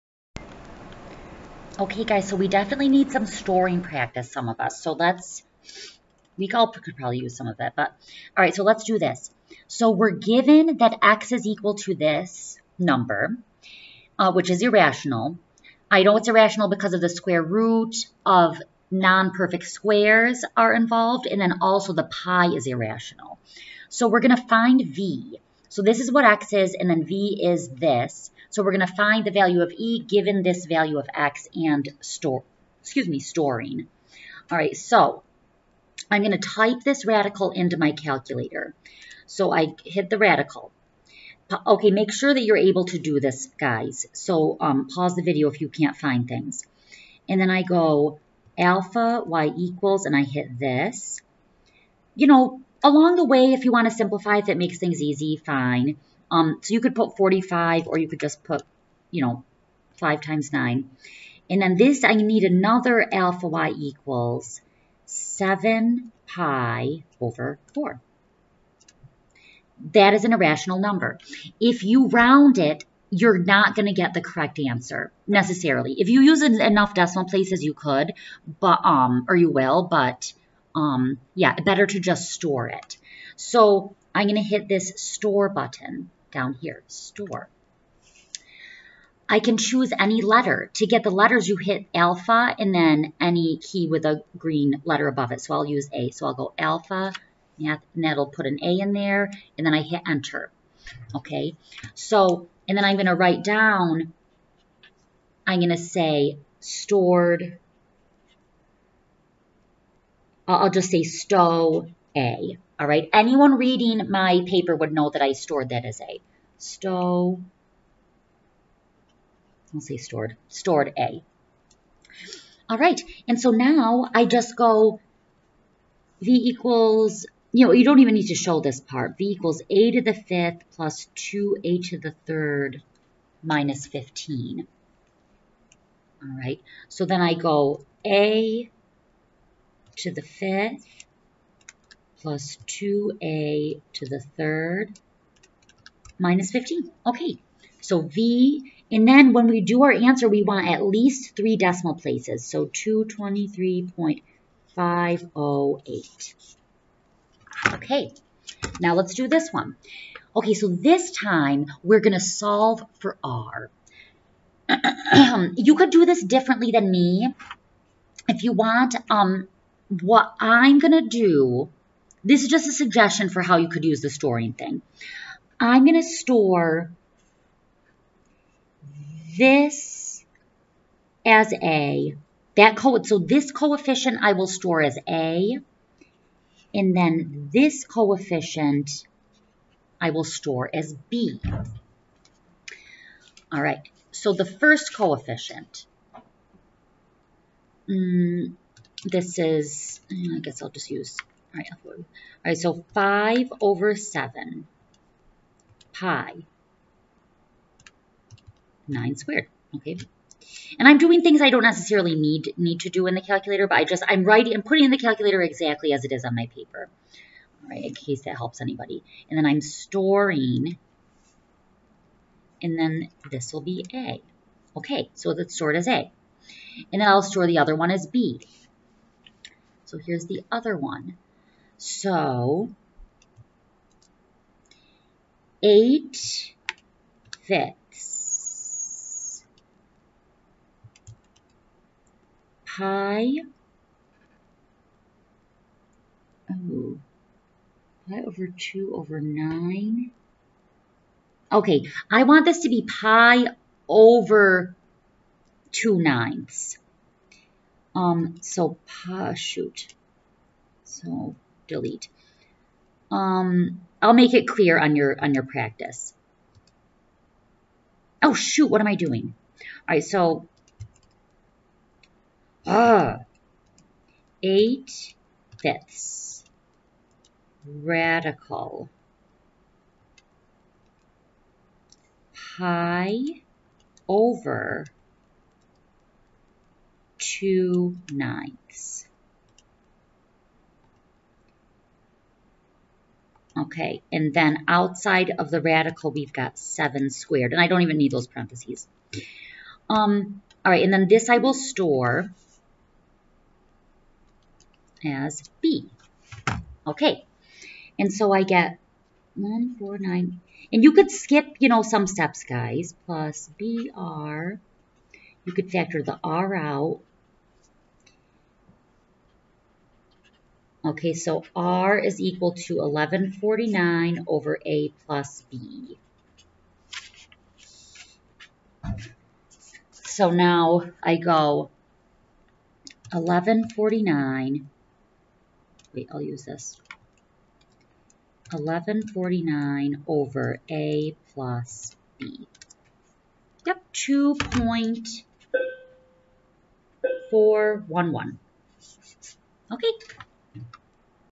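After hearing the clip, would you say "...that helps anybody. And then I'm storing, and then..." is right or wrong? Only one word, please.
right.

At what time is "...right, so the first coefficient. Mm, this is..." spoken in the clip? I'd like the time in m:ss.
3:13.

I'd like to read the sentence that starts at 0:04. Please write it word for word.
So let's, we all could probably use some of it, but all right, so let's do this.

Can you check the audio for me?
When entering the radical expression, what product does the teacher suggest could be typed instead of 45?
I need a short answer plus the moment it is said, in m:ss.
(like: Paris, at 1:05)
5 times 9, at 0:59.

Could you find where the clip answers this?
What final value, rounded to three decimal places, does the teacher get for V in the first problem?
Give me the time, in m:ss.
2:32.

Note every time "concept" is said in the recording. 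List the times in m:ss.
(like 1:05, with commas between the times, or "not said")
not said.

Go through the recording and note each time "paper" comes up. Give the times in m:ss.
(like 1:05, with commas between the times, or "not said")
1:54, 3:36.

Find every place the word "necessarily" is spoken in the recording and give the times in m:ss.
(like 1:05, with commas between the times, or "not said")
1:15, 3:31.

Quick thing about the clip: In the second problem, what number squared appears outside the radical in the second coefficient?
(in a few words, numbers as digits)
7.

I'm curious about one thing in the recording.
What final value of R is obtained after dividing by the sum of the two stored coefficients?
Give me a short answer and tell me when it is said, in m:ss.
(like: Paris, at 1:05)
2.411, at 5:43.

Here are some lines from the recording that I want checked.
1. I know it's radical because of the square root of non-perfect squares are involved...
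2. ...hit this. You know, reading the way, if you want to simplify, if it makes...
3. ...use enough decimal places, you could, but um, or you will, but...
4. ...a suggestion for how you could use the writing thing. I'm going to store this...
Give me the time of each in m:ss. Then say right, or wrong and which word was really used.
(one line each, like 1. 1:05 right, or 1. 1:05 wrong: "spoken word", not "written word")
1. 0:15 wrong: "irrational", not "radical"
2. 0:50 wrong: "along", not "reading"
3. 1:16 right
4. 2:52 wrong: "storing", not "writing".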